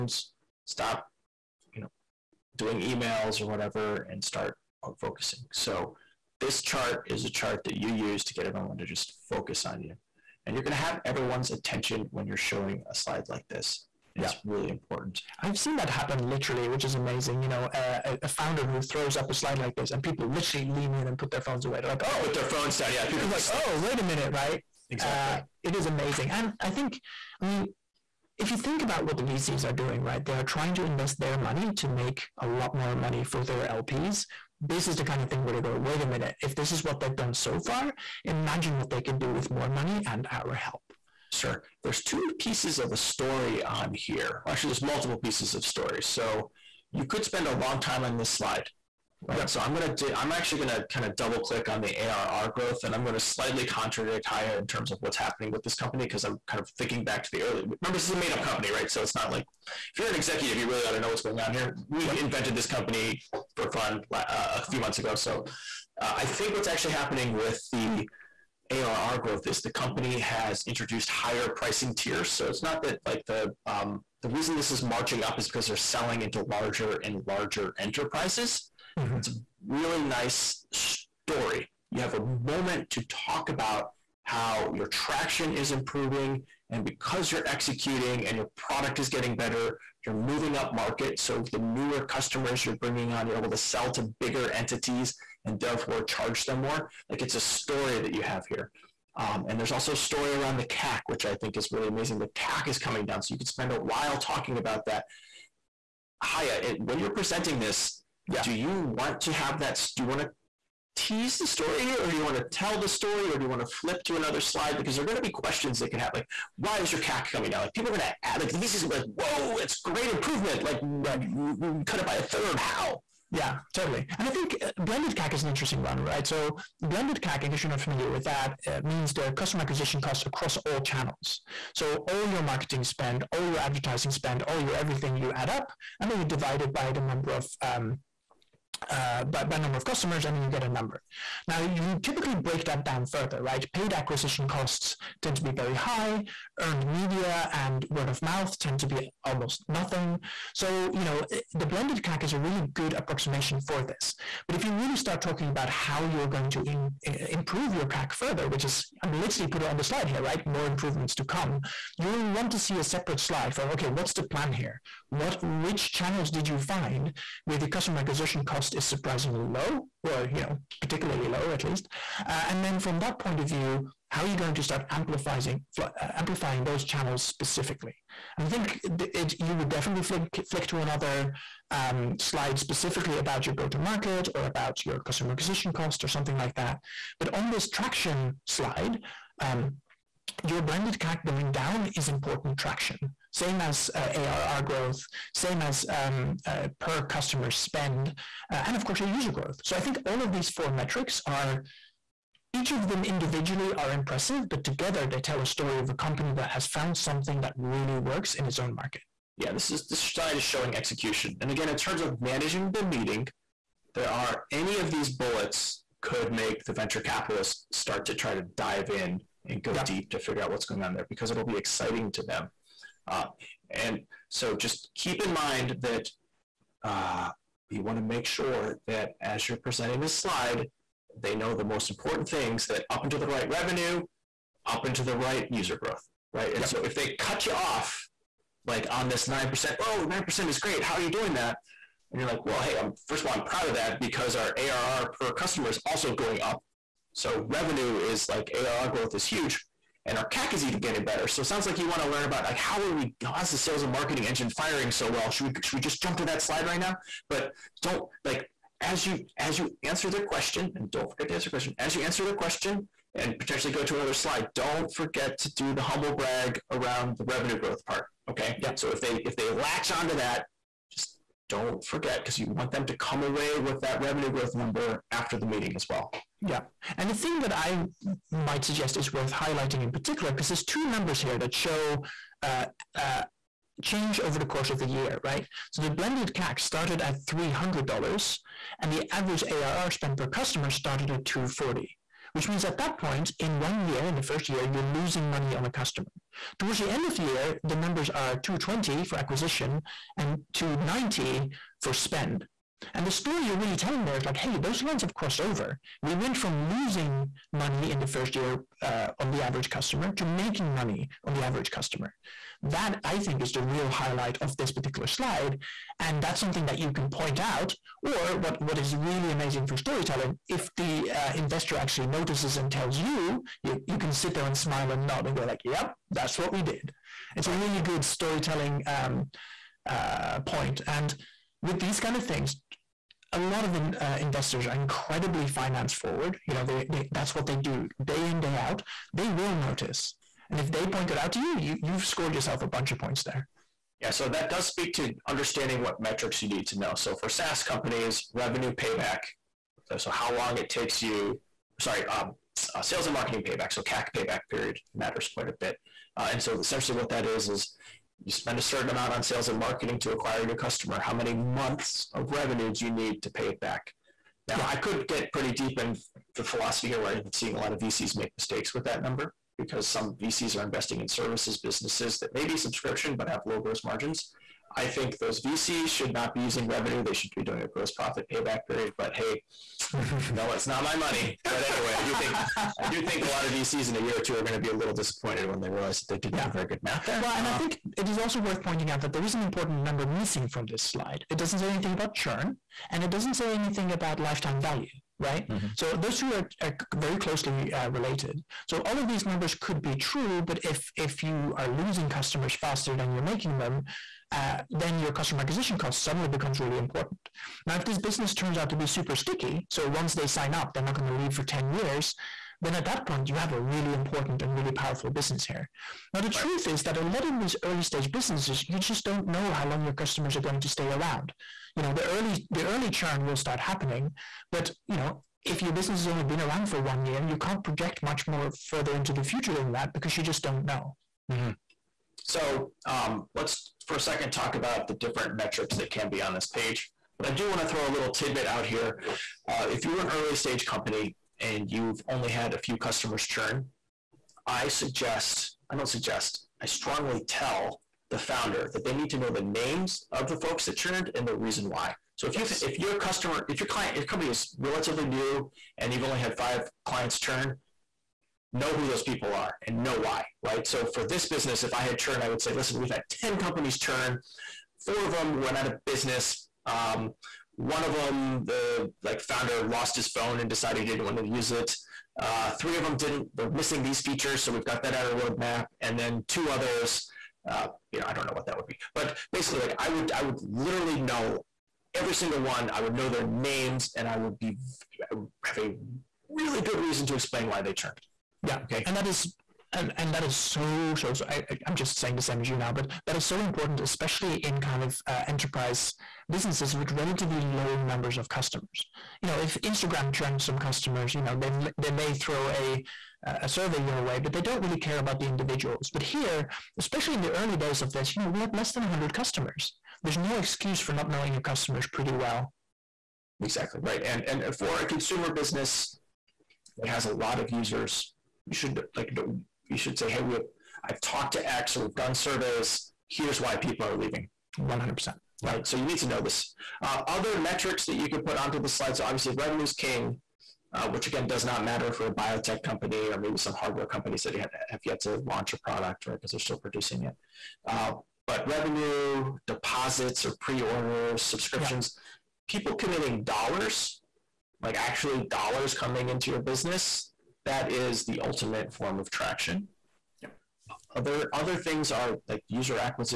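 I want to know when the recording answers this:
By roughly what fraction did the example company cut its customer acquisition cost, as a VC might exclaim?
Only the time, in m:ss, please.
2:02.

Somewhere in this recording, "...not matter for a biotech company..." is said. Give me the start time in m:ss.
8:51.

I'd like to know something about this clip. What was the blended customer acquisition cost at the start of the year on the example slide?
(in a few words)
$300.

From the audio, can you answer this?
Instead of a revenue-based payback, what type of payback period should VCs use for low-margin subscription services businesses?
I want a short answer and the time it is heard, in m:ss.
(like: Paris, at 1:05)
gross profit payback period, at 6:17.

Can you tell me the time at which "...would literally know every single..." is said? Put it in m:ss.
8:00.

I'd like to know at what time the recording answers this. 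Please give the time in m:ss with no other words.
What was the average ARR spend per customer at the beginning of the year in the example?
4:51.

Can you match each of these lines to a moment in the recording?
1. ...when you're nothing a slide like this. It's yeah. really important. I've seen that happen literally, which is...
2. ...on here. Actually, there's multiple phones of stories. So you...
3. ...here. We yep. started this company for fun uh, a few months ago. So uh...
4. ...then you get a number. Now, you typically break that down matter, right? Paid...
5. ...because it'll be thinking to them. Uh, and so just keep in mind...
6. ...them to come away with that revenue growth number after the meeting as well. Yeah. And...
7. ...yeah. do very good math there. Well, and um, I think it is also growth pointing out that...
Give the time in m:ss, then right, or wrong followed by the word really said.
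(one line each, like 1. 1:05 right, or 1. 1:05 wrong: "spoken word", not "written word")
1. 0:12 wrong: "showing", not "nothing"
2. 0:43 wrong: "pieces", not "phones"
3. 1:01 wrong: "invented", not "started"
4. 2:20 wrong: "further", not "matter"
5. 3:41 wrong: "exciting", not "thinking"
6. 4:32 right
7. 6:26 wrong: "worth", not "growth".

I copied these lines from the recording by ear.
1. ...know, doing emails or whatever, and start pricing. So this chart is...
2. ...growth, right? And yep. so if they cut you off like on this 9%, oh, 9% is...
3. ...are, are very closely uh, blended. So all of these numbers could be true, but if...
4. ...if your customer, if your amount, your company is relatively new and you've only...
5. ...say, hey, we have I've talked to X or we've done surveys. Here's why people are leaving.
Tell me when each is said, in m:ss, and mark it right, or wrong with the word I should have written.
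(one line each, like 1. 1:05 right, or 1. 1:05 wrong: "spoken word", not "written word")
1. 0:01 wrong: "focusing", not "pricing"
2. 3:55 right
3. 6:36 wrong: "related", not "blended"
4. 7:32 wrong: "client", not "amount"
5. 8:39 right.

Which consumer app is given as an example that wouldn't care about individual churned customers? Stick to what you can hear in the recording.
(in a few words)
Instagram.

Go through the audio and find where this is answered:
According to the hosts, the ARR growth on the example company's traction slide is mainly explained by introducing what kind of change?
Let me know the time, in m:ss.
1:11.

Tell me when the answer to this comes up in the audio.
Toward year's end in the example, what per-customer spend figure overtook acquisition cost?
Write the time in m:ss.
5:00.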